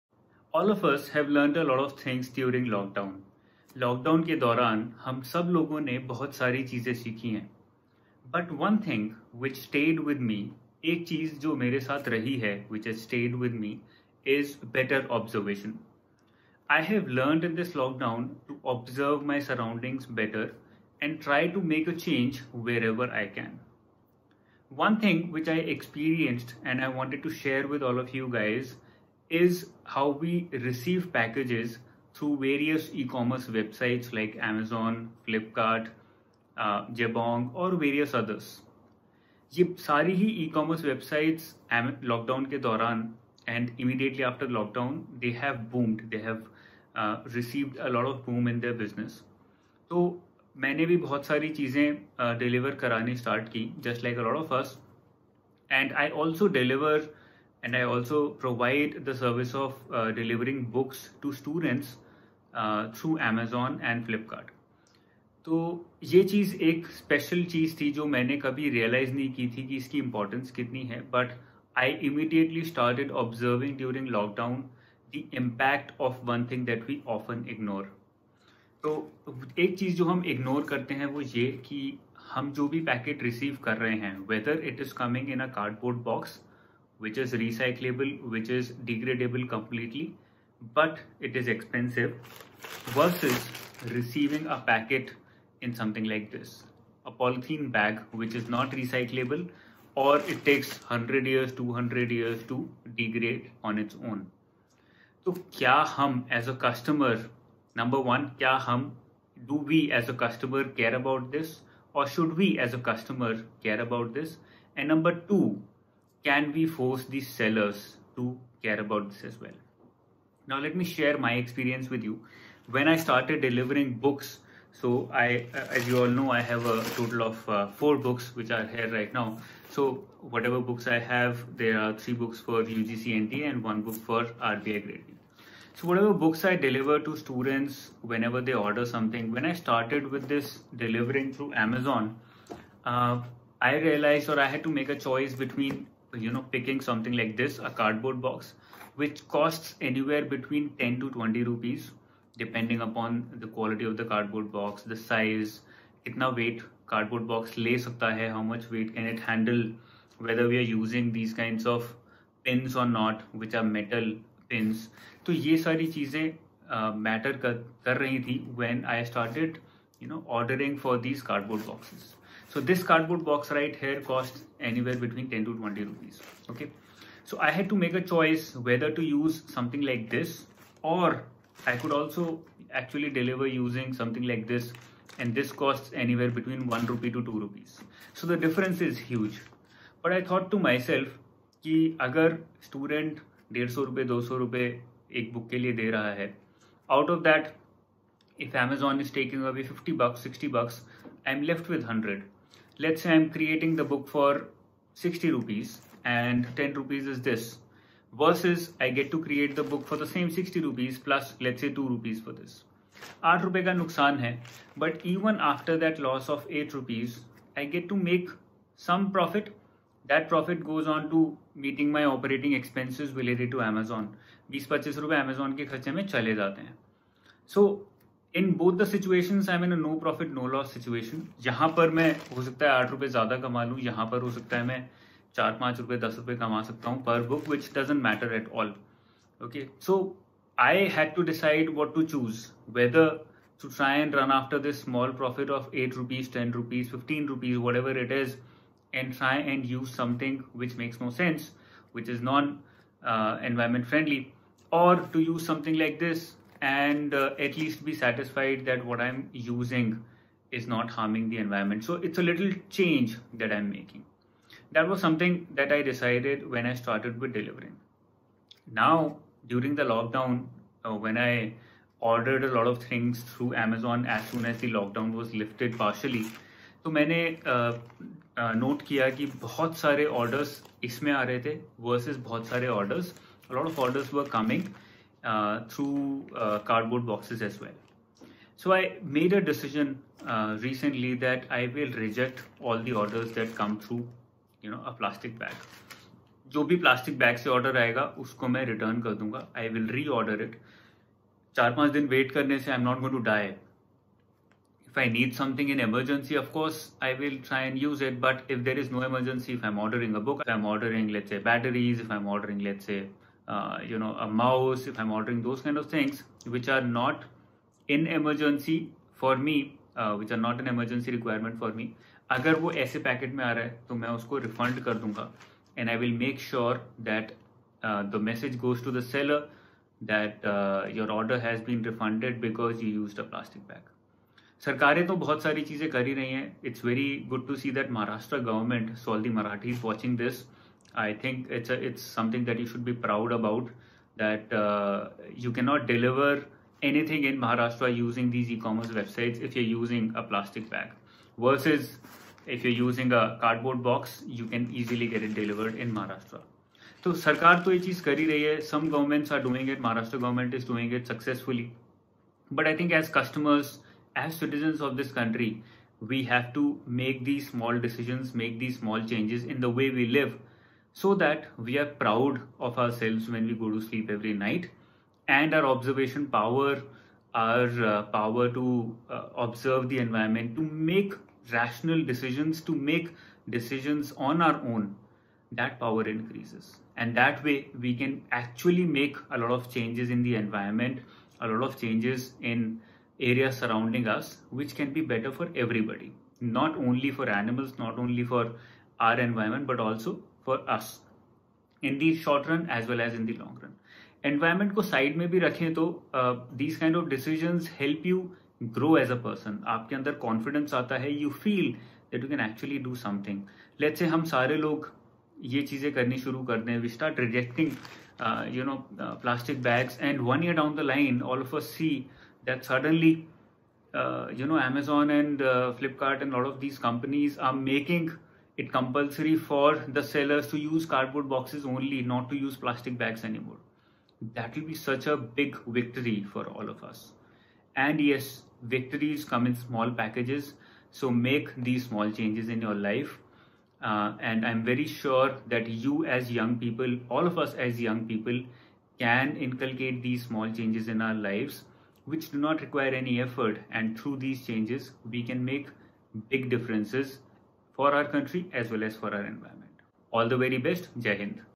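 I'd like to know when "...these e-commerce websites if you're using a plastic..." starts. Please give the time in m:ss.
5:48.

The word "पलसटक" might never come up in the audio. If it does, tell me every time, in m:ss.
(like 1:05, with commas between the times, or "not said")
4:56, 6:59.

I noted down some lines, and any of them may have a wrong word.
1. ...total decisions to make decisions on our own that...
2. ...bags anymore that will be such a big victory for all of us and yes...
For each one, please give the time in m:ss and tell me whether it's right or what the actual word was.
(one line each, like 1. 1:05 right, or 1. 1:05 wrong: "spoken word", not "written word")
1. 6:21 wrong: "rational", not "total"
2. 7:12 right.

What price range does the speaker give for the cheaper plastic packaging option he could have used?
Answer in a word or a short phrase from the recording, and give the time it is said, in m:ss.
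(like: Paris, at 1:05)
1 to 2 rupees, at 3:06.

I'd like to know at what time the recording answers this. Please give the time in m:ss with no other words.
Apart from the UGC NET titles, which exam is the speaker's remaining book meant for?
2:14.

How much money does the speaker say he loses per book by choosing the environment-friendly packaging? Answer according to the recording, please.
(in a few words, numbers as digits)
8 rupees.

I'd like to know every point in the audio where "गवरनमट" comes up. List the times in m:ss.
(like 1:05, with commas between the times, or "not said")
5:38.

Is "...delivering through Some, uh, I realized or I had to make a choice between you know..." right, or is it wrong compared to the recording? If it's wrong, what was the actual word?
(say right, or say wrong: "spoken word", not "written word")
wrong: "Amazon", not "Some".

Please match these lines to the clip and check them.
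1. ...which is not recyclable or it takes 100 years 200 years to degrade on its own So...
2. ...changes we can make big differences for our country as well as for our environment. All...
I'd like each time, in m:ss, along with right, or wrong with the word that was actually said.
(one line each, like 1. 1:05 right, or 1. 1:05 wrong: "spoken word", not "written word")
1. 1:38 right
2. 7:34 right.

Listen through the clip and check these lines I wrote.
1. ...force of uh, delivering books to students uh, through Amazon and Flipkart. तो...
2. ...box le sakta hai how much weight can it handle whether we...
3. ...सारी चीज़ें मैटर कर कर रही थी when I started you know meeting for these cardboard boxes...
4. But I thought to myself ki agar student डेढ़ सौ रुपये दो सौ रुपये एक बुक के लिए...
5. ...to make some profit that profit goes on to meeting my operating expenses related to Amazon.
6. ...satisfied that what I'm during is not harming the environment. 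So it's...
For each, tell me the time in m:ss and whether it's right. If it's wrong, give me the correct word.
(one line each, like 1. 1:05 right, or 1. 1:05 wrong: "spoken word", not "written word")
1. 0:59 wrong: "service", not "force"
2. 2:37 right
3. 2:45 wrong: "ordering", not "meeting"
4. 3:10 right
5. 3:37 right
6. 4:17 wrong: "using", not "during".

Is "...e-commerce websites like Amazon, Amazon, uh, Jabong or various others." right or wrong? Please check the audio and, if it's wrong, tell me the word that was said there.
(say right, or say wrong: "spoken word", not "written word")
wrong: "Flipkart", not "Amazon".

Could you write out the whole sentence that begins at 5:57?
So, Sarkar to ये चीज़ कर ही Some governments are doing it.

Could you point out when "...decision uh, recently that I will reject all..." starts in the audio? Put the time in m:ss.
4:49.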